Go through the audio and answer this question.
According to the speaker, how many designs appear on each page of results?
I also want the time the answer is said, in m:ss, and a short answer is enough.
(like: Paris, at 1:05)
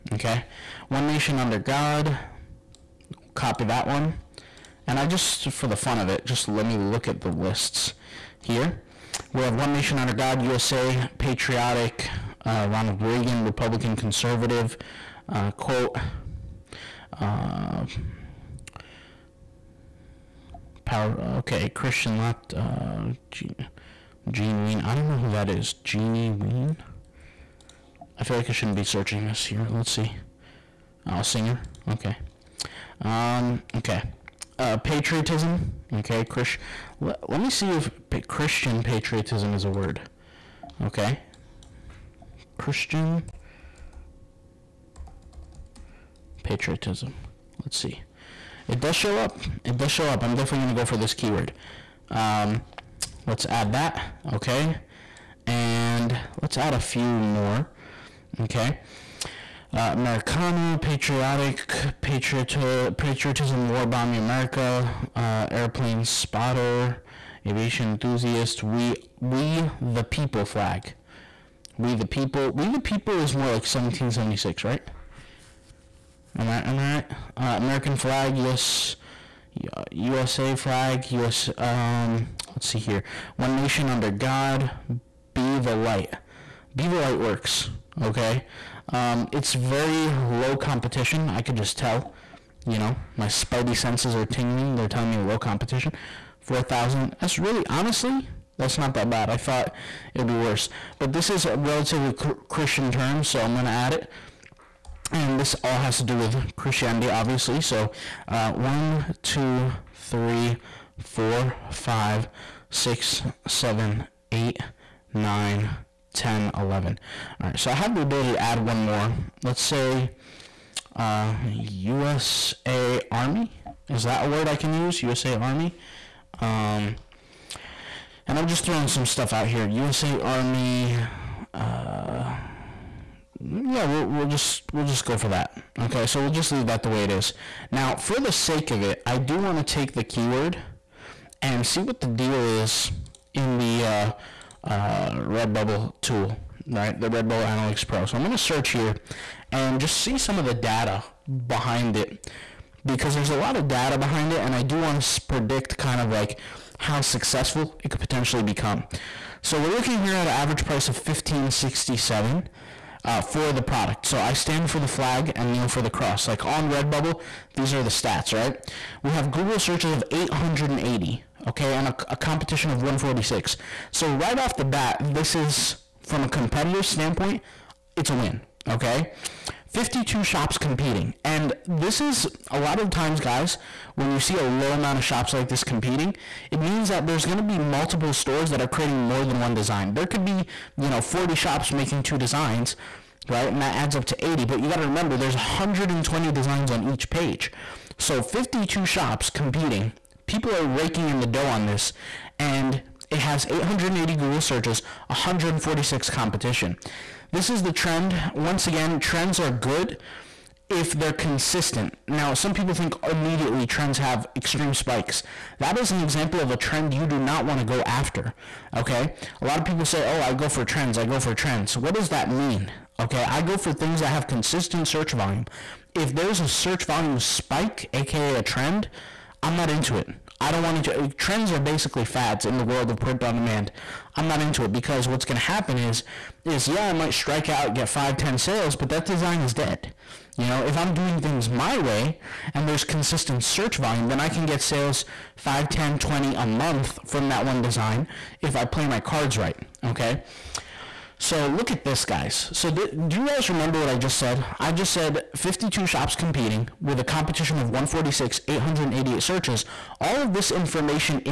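120, at 3:15.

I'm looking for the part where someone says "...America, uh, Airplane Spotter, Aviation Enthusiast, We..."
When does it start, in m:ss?
1:04.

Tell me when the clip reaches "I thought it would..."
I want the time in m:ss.
1:39.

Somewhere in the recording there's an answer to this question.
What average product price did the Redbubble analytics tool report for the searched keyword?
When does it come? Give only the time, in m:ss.
2:40.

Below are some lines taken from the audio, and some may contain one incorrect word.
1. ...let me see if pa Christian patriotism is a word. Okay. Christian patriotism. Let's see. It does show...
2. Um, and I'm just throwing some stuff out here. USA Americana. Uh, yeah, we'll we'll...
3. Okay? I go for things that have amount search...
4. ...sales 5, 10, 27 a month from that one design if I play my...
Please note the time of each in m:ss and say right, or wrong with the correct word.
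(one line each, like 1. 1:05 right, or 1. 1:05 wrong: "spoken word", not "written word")
1. 0:37 right
2. 2:06 wrong: "Army", not "Americana"
3. 3:42 wrong: "consistent", not "amount"
4. 4:04 wrong: "20", not "27".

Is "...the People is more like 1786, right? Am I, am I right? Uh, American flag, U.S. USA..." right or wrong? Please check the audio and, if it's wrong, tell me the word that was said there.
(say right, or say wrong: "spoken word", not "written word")
wrong: "1776", not "1786".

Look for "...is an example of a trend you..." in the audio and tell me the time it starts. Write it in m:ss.
3:35.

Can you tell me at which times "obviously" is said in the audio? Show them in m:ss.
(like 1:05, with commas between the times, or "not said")
1:47.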